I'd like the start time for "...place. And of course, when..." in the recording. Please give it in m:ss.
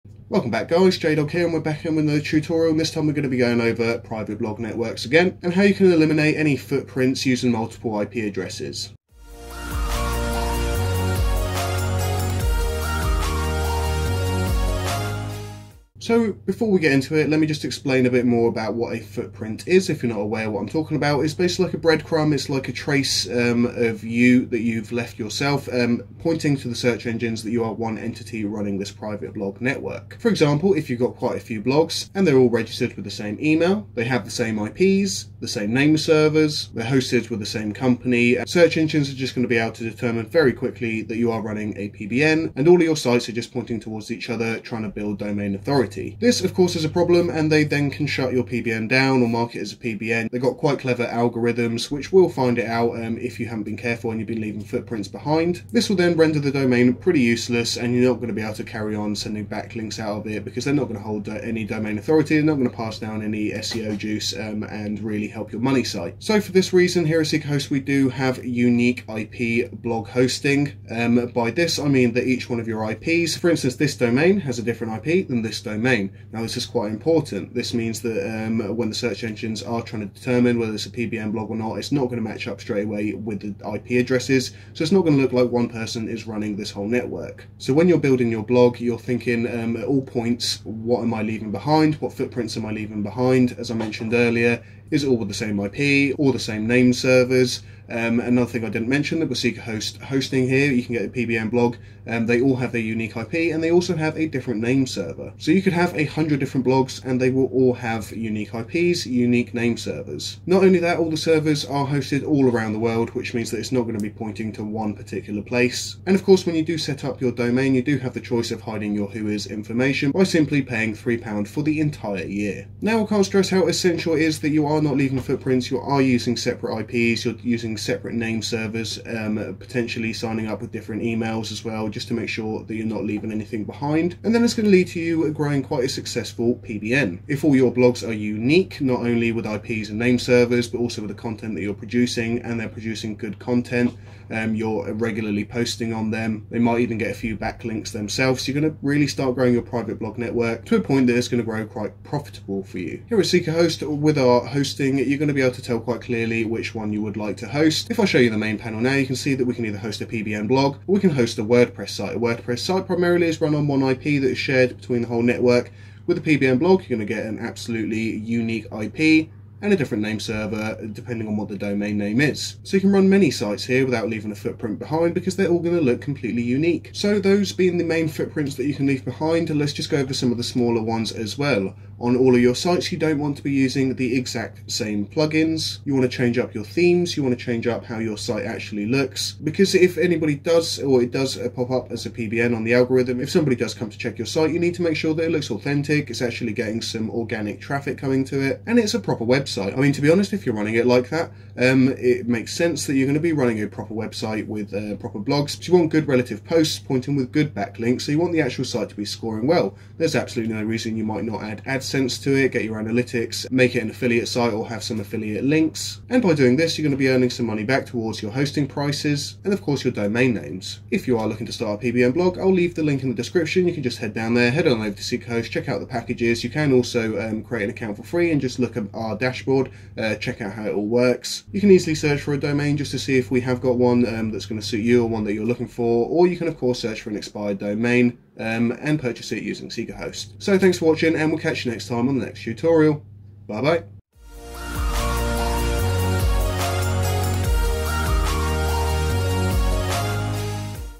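1:55.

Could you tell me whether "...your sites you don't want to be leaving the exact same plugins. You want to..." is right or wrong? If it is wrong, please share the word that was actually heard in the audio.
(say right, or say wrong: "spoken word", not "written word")
wrong: "using", not "leaving".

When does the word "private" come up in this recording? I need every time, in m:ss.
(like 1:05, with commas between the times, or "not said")
0:03, 0:28, 2:29.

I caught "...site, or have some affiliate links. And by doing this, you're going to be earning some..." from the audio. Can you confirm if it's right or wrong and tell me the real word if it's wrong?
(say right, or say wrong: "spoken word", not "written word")
right.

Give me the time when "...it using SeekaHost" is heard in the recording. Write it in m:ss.
3:59.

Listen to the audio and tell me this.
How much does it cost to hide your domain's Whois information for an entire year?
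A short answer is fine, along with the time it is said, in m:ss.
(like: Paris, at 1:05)
£3, at 2:00.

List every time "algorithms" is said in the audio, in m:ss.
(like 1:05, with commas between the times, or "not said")
0:51, 3:12.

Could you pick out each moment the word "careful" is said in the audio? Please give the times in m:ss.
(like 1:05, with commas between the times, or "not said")
0:53.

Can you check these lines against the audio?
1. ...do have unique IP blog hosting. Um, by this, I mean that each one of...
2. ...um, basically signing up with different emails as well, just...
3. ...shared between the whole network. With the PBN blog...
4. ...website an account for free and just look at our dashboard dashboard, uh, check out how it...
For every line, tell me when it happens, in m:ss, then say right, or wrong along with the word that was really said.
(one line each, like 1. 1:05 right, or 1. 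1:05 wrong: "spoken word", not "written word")
1. 1:07 right
2. 2:09 wrong: "potentially", not "basically"
3. 2:44 right
4. 3:47 wrong: "create", not "website".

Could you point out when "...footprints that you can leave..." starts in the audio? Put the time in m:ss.
2:58.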